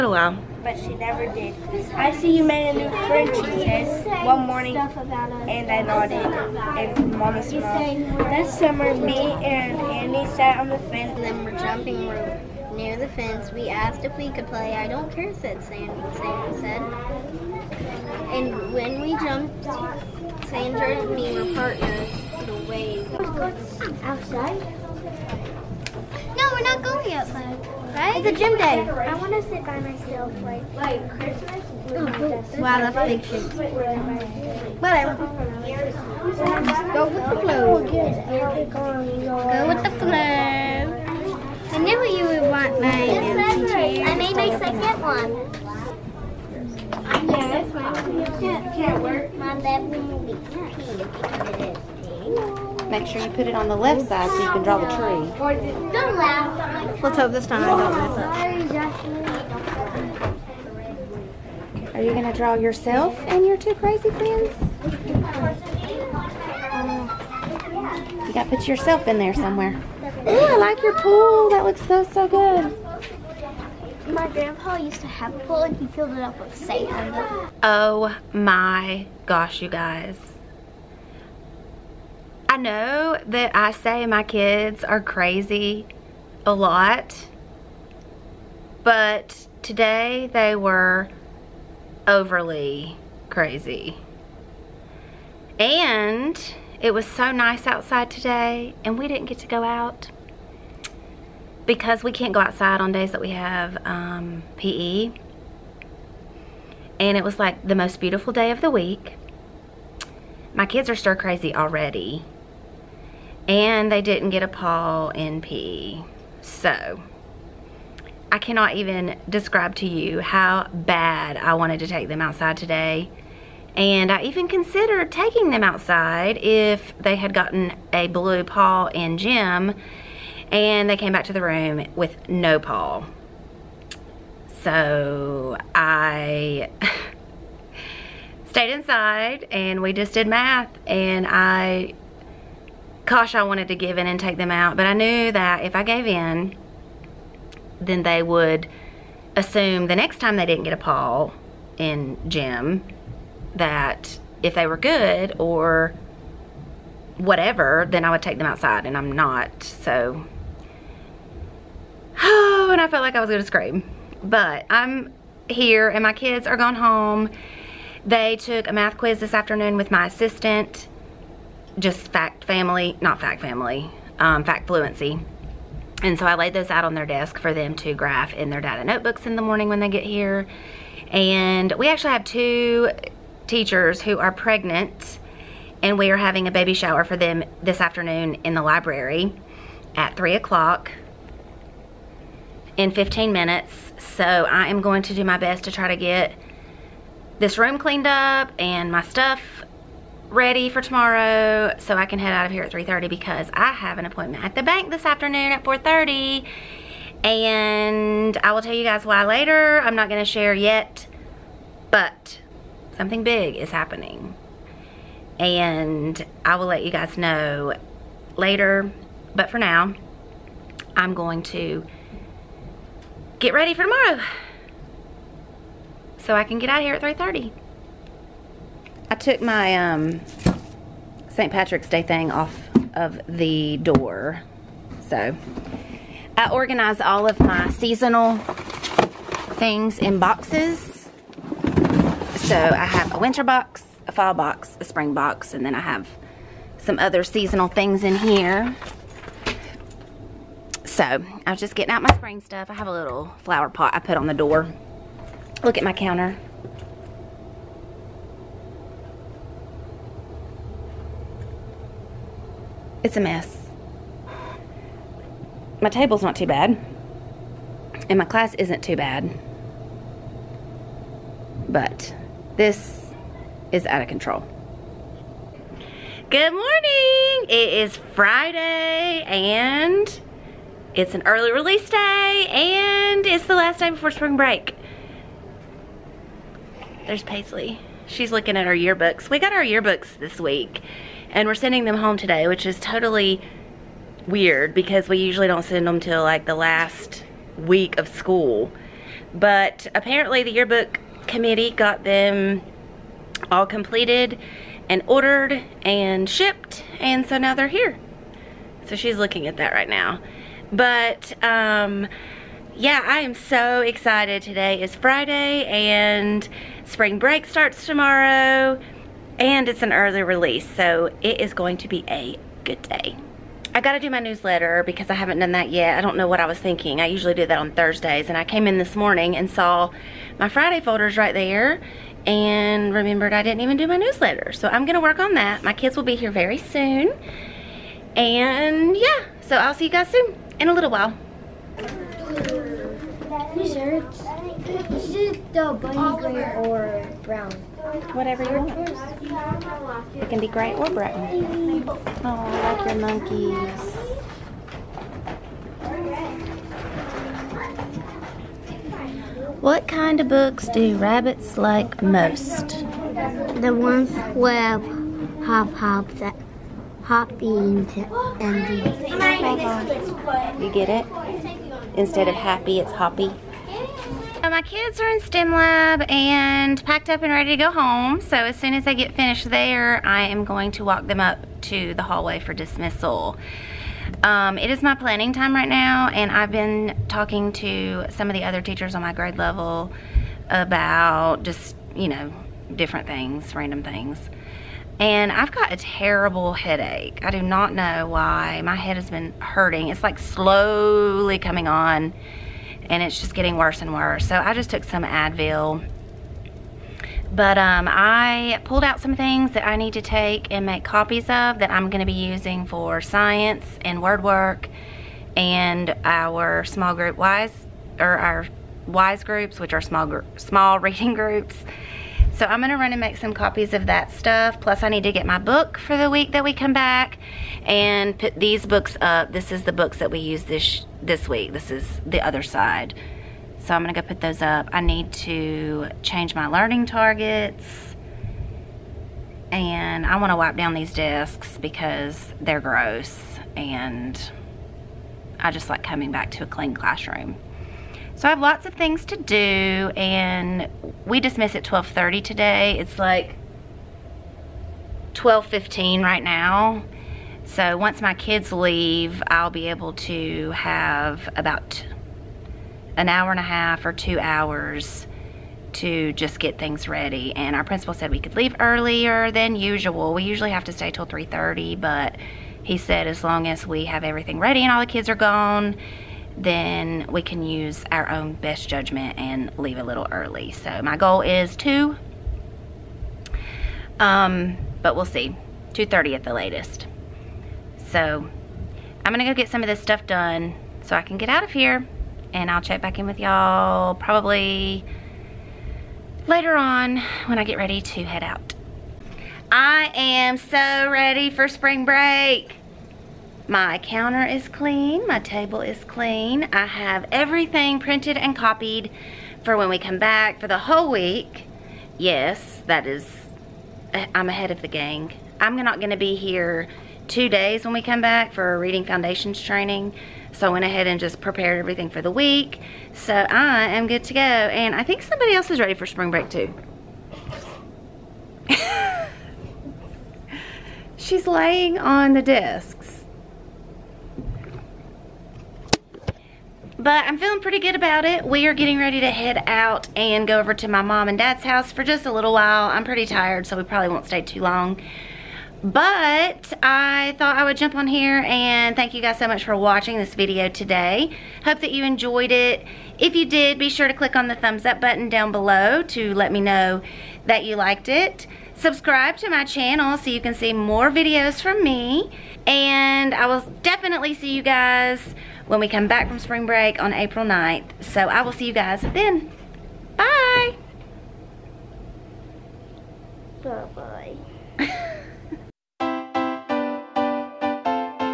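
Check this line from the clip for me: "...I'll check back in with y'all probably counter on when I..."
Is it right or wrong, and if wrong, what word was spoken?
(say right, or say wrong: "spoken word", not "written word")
wrong: "later", not "counter".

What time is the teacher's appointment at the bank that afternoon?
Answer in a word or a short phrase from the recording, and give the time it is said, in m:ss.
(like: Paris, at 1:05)
4:30, at 3:25.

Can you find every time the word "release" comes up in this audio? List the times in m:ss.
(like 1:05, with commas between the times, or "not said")
4:41, 5:20.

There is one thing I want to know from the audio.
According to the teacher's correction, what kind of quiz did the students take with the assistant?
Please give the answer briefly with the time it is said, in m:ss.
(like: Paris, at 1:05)
fact fluency, at 2:54.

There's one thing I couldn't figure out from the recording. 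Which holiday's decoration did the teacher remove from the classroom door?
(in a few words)
St. Patrick's Day.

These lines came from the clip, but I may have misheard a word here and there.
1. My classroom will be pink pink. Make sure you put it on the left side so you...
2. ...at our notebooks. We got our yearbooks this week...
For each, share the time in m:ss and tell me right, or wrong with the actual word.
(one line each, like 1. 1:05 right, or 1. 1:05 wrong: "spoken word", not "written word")
1. 0:49 wrong: "bedroom", not "classroom"
2. 4:48 wrong: "yearbooks", not "notebooks".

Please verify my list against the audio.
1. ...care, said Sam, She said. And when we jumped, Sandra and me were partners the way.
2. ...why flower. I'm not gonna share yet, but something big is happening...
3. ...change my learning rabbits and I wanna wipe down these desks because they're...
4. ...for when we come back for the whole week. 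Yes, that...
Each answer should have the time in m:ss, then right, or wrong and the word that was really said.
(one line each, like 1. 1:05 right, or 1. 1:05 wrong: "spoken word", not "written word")
1. 0:15 wrong: "Sandy", not "She"
2. 3:29 wrong: "later", not "flower"
3. 7:16 wrong: "targets", not "rabbits"
4. 8:29 right.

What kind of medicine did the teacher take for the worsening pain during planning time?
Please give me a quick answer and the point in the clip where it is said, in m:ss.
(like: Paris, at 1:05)
Advil, at 6:45.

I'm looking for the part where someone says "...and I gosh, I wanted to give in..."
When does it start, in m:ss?
2:20.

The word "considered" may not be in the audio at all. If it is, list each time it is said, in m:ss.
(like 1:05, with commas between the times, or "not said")
2:04.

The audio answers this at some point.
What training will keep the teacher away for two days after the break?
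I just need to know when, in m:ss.
8:38.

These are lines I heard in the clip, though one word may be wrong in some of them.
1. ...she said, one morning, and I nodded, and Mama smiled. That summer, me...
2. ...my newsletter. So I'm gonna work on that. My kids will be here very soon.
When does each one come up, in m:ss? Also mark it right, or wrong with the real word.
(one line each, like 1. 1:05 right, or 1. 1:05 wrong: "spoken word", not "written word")
1. 0:03 right
2. 5:33 right.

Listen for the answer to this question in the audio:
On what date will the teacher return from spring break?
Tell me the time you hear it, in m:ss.
9:26.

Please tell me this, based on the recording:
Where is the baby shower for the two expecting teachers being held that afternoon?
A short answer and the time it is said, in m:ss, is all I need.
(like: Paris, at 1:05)
the library, at 3:08.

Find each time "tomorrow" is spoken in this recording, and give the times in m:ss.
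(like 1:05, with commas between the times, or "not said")
3:20, 3:43, 5:17.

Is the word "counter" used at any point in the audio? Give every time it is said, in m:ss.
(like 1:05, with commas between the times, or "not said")
4:15, 8:23.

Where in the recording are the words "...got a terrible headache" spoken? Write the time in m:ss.
6:35.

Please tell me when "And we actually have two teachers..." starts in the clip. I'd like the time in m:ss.
3:01.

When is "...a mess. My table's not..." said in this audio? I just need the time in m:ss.
4:23.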